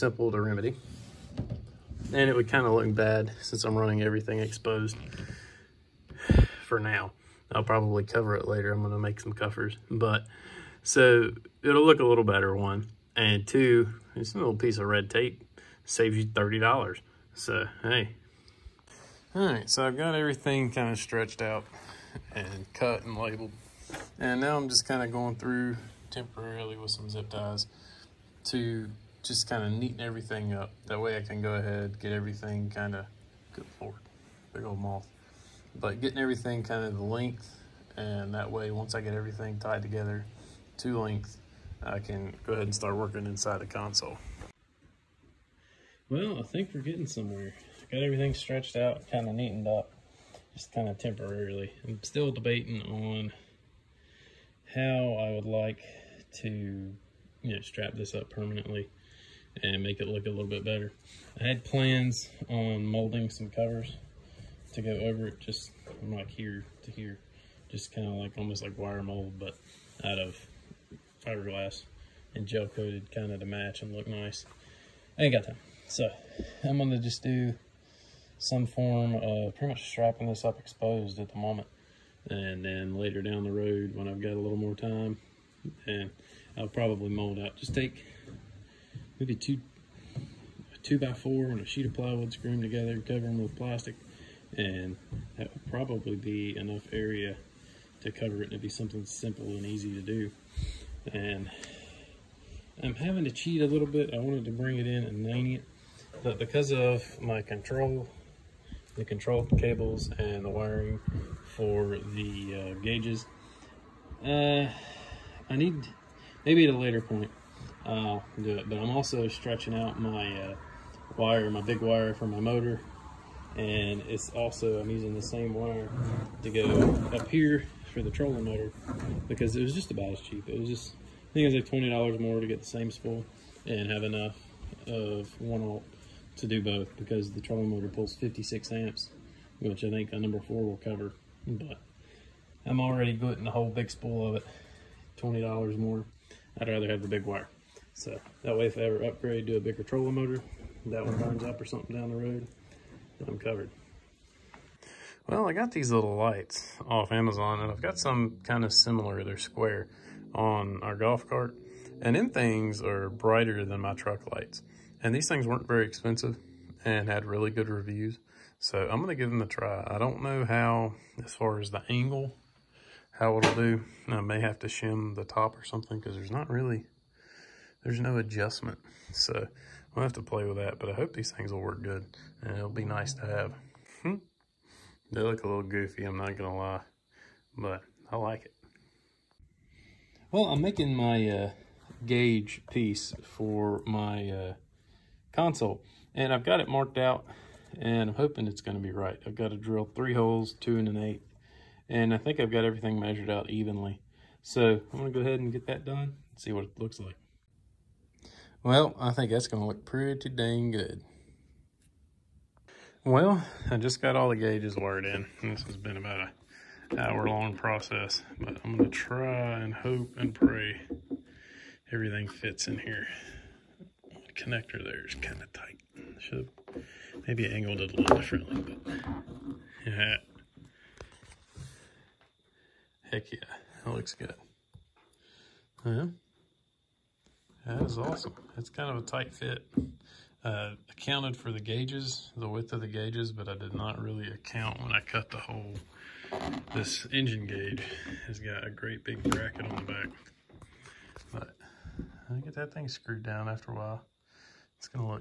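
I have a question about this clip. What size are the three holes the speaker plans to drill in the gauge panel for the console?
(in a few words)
2 1/8 inch.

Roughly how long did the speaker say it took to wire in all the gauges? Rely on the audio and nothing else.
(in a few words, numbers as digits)
About an hour.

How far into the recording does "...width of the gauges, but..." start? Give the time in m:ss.
4:02.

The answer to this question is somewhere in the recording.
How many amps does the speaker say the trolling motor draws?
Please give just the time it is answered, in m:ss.
2:18.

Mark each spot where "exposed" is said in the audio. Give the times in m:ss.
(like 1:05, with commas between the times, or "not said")
0:04, 1:20.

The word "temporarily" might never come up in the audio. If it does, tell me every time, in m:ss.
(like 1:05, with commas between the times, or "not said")
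0:26, 0:50.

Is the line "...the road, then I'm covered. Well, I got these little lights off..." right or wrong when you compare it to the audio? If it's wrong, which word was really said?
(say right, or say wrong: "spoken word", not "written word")
right.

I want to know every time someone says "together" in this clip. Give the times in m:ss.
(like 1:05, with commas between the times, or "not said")
0:39, 1:32.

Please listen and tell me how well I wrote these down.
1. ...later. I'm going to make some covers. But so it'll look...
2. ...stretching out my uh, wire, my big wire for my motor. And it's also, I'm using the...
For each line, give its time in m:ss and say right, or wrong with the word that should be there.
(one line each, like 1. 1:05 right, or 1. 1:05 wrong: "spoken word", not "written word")
1. 0:08 right
2. 1:59 right.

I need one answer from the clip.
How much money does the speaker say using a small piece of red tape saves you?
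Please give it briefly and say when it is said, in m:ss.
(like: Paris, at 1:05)
$30, at 0:16.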